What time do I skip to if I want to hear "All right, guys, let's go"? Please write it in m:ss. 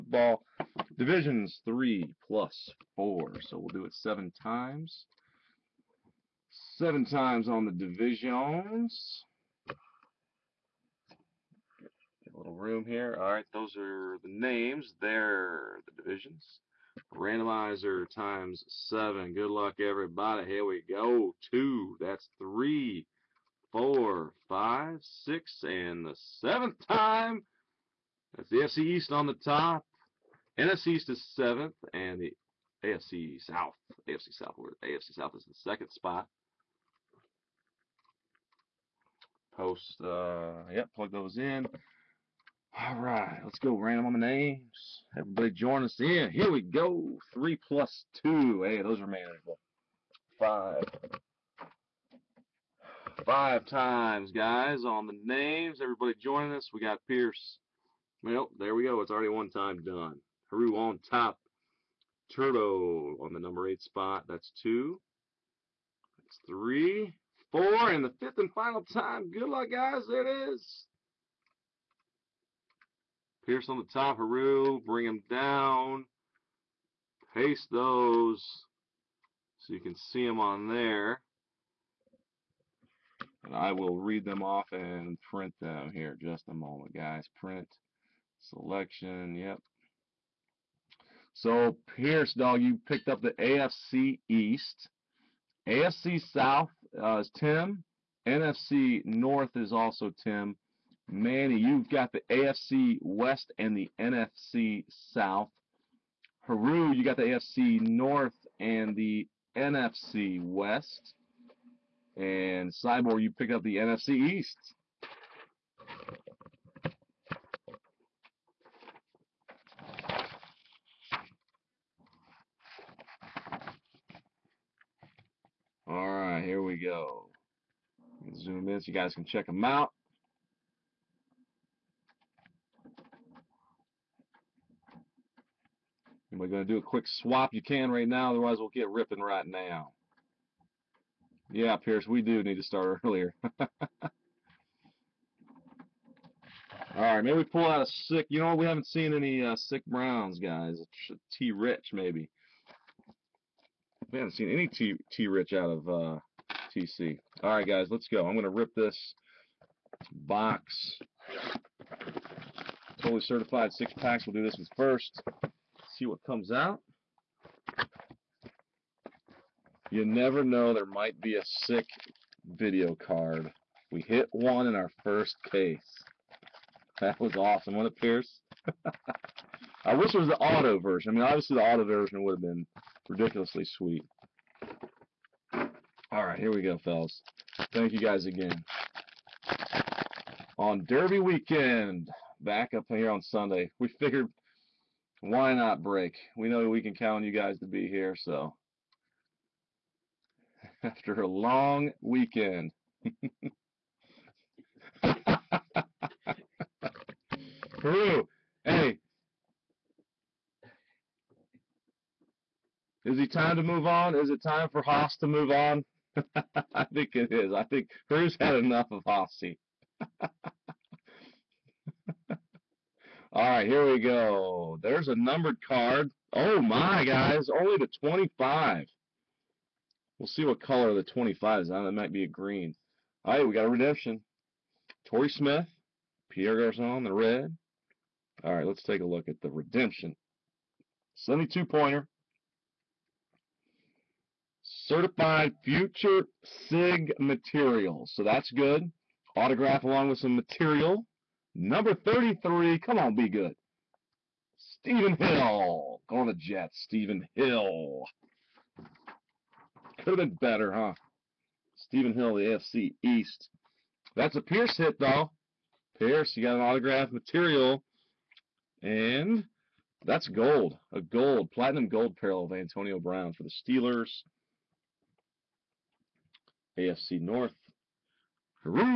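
2:37.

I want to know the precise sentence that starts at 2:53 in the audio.
We hit one in our first case.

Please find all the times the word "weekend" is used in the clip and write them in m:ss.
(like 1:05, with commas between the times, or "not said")
3:11, 3:22.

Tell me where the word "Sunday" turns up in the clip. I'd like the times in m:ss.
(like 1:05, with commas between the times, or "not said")
3:13.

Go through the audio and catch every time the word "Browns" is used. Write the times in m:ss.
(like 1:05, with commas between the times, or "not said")
2:29, 4:32.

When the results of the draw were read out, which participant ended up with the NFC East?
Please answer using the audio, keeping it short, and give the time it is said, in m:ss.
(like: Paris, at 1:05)
Cyborg, at 1:52.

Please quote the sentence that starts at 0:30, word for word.
NFC East is seventh, and the AFC South.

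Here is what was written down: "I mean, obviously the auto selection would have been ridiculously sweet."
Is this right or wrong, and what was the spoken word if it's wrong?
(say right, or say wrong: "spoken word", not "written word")
wrong: "version", not "selection".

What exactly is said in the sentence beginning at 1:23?
And I will read them off and print them here just a moment, guys.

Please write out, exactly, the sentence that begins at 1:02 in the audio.
Turtle on the number eight spot.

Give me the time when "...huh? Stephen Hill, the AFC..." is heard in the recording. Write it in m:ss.
4:20.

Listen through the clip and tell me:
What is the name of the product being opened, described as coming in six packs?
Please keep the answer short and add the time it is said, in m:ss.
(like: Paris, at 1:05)
Totally Certified, at 2:43.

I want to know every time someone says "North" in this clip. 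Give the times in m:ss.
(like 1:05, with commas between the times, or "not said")
1:39, 1:47, 4:37.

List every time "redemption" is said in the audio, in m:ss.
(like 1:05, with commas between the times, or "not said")
3:53, 3:59.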